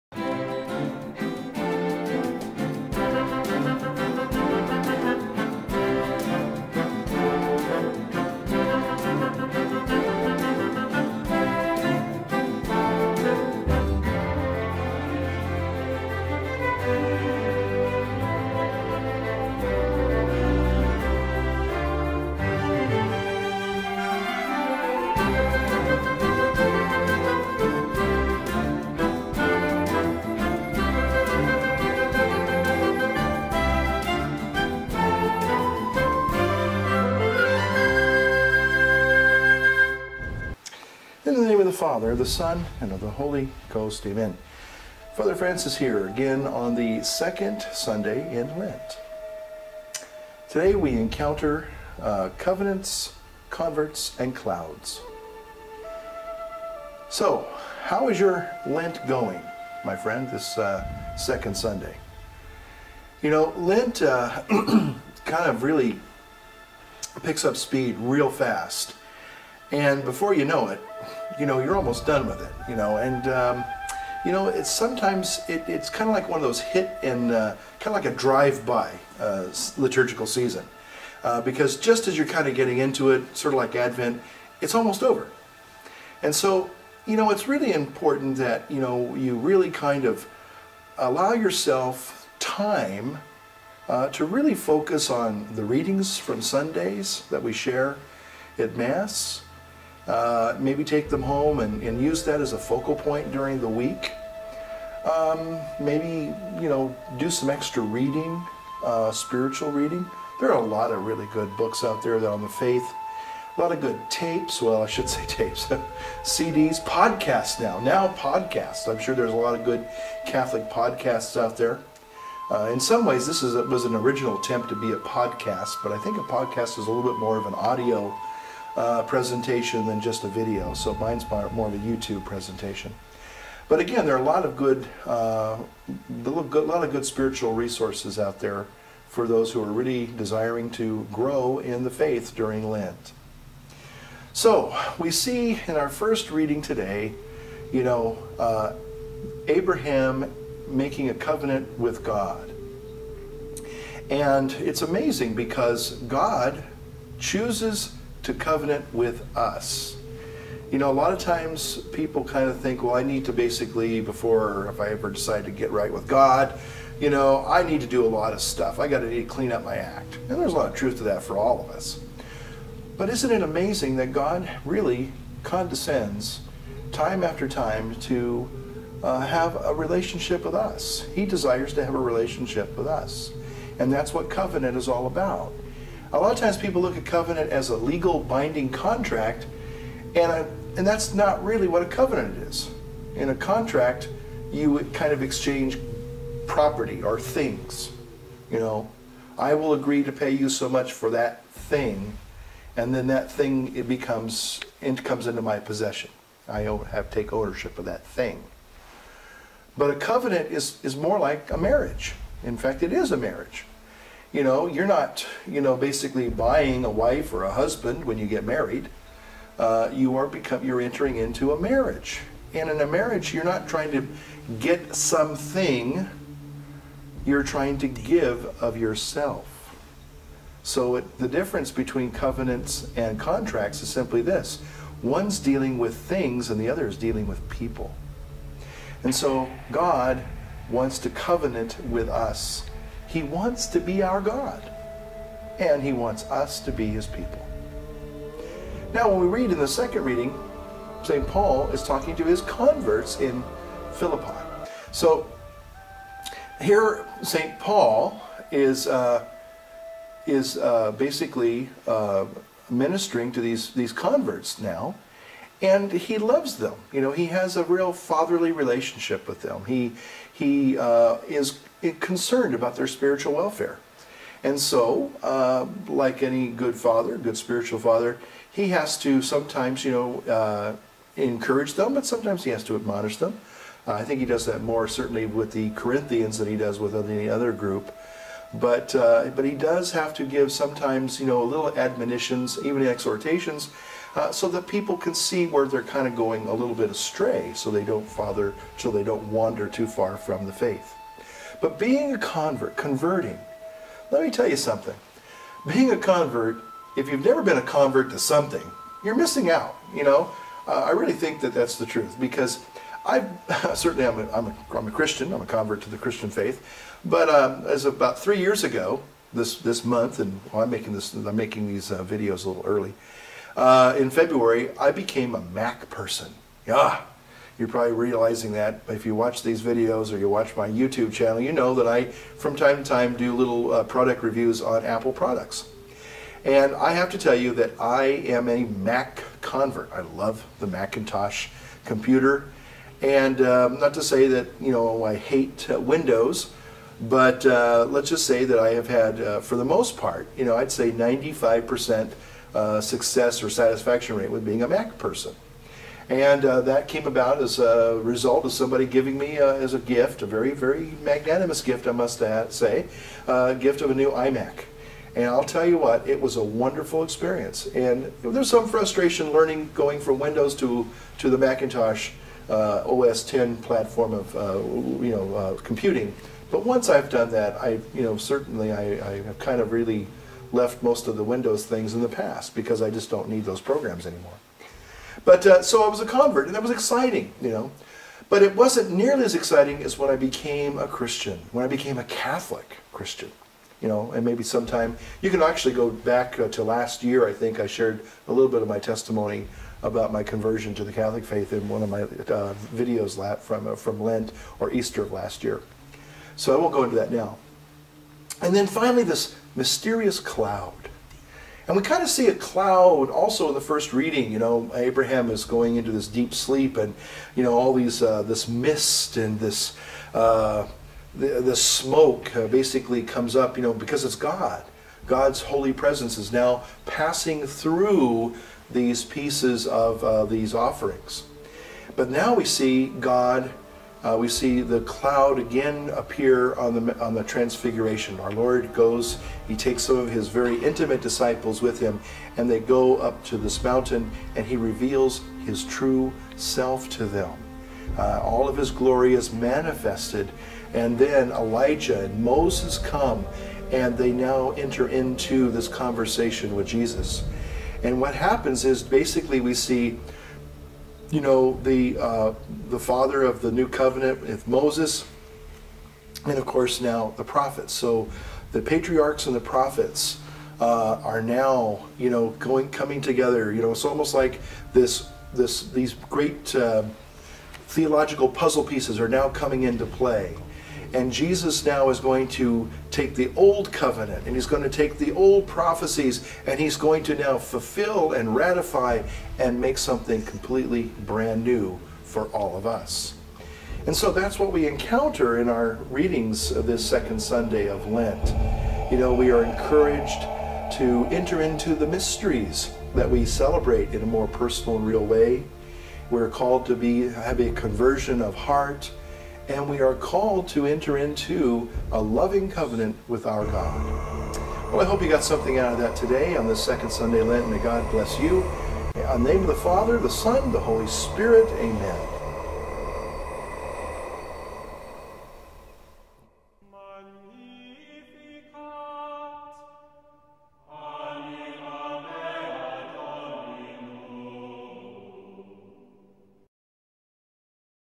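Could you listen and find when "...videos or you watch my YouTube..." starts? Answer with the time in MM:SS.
05:29.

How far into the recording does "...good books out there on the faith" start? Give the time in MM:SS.
01:51.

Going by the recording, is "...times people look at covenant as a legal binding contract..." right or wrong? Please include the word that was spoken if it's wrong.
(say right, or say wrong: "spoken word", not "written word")
right.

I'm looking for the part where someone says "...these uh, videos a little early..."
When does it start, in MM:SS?
05:21.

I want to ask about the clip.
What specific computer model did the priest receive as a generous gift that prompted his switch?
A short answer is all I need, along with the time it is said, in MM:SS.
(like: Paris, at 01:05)
iMac, at 06:04.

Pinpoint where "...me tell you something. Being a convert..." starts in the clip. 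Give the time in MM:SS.
05:04.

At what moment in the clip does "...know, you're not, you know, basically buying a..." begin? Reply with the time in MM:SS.
03:34.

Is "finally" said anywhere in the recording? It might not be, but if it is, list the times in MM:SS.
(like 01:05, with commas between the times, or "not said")
06:48.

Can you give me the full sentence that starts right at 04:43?
Uh, I think he does that more certainly with the Corinthians than he does with any other group.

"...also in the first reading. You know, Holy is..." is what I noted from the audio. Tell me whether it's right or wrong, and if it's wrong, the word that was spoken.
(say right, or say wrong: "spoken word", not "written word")
wrong: "Abraham", not "Holy".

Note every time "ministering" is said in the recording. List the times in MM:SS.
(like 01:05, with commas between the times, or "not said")
04:22.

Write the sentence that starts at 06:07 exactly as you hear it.
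And there's some frustration learning going from Windows to, to the Macintosh uh, OS 10 platform of uh, you know uh, computing.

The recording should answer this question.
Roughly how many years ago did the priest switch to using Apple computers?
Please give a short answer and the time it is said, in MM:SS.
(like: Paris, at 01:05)
3, at 05:18.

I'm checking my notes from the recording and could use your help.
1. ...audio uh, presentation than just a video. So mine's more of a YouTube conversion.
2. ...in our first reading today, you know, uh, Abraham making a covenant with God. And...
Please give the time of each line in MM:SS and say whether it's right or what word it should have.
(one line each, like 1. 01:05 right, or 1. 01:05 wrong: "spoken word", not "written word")
1. 02:07 wrong: "presentation", not "conversion"
2. 02:25 right.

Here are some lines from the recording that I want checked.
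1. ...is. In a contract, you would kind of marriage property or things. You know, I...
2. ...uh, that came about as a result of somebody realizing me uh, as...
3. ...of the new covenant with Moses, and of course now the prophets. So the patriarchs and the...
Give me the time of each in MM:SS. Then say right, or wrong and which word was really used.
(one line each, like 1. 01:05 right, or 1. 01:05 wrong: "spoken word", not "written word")
1. 03:12 wrong: "exchange", not "marriage"
2. 05:56 wrong: "giving", not "realizing"
3. 07:43 right.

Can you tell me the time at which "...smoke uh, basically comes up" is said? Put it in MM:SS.
07:01.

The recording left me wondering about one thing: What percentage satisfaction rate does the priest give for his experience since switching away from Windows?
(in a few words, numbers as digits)
95%.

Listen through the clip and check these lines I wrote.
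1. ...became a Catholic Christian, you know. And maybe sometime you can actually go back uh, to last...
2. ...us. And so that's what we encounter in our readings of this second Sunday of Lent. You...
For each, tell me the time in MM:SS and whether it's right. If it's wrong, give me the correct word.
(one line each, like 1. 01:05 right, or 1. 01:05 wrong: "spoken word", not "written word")
1. 06:31 right
2. 08:12 right.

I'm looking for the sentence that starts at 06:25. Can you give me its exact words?
But uh, so I was a convert, and that was exciting, you know.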